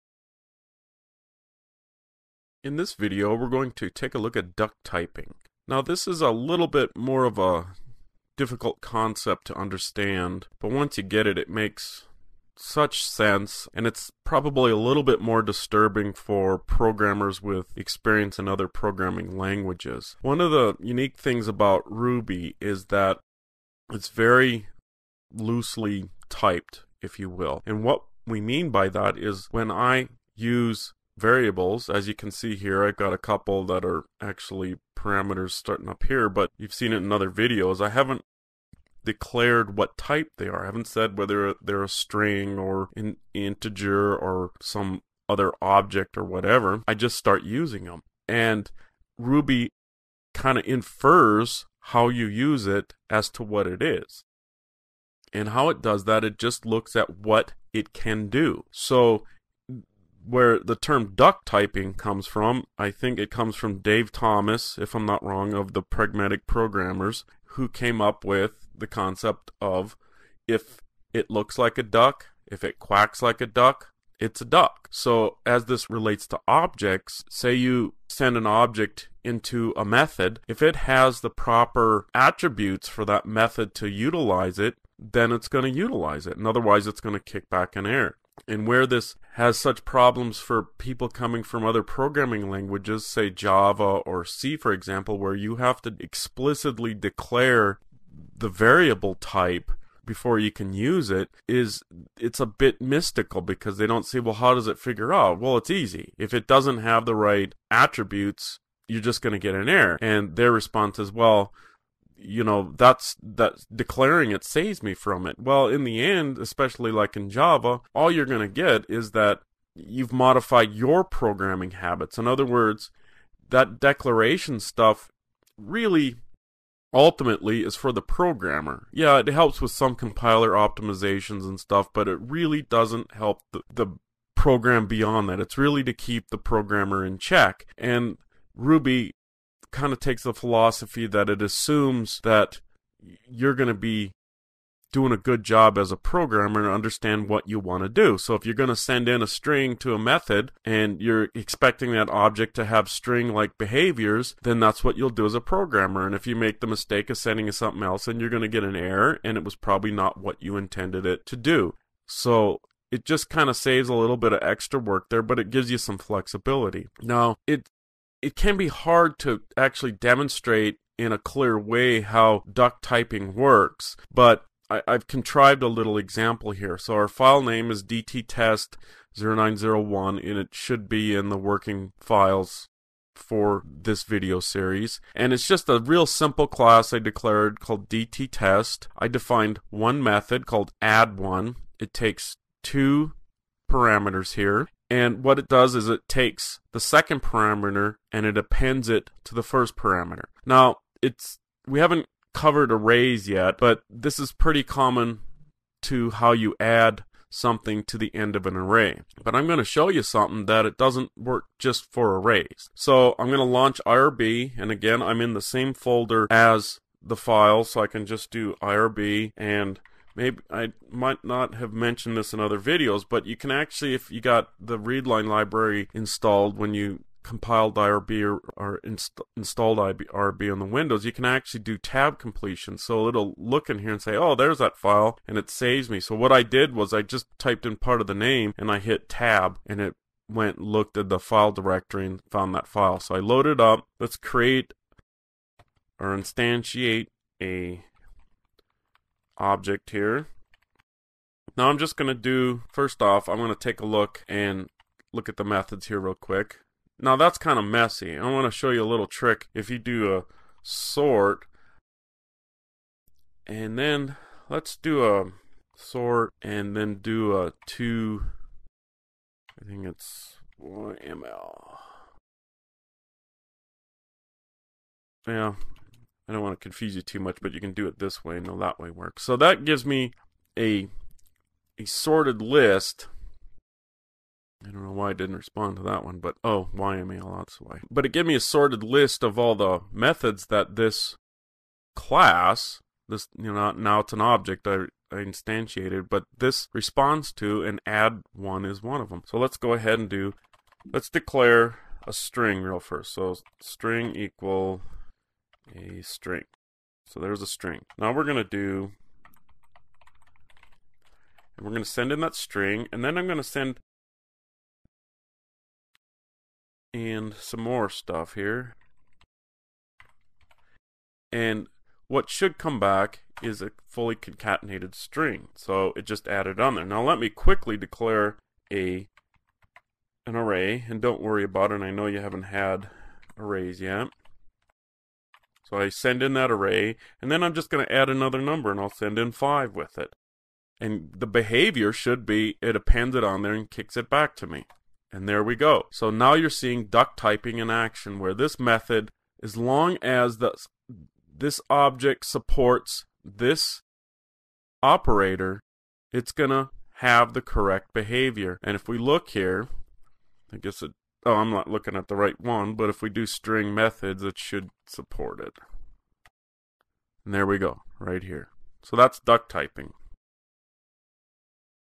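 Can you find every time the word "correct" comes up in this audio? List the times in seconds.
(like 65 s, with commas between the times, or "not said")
357 s.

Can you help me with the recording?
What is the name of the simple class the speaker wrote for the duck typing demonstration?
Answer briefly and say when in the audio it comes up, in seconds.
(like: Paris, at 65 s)
dttest, at 187 s.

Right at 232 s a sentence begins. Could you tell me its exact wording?
So it'll look in here and say, oh, there's that file, and it saves me.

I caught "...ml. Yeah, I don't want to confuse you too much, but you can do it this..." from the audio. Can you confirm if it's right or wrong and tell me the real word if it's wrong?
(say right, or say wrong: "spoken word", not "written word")
right.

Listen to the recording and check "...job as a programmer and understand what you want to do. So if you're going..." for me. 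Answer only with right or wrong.
right.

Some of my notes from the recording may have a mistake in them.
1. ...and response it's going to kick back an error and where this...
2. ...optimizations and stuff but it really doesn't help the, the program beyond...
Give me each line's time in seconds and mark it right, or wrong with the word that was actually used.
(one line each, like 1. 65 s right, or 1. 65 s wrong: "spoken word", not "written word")
1. 86 s wrong: "otherwise", not "response"
2. 130 s right.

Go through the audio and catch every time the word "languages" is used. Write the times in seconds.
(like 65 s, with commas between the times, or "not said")
19 s, 92 s.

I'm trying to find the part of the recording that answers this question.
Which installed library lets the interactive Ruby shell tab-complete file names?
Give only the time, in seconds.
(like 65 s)
224 s.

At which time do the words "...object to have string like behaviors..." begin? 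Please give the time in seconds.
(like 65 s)
152 s.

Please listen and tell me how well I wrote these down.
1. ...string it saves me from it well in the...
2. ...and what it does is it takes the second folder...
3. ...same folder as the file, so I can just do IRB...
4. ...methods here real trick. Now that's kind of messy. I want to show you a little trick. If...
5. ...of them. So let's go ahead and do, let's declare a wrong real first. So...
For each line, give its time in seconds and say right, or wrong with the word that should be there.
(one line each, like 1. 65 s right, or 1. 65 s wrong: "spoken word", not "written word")
1. 113 s wrong: "declaring", not "string"
2. 194 s wrong: "parameter", not "folder"
3. 215 s right
4. 255 s wrong: "quick", not "trick"
5. 299 s wrong: "string", not "wrong".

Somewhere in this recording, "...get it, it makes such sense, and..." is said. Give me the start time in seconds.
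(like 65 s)
11 s.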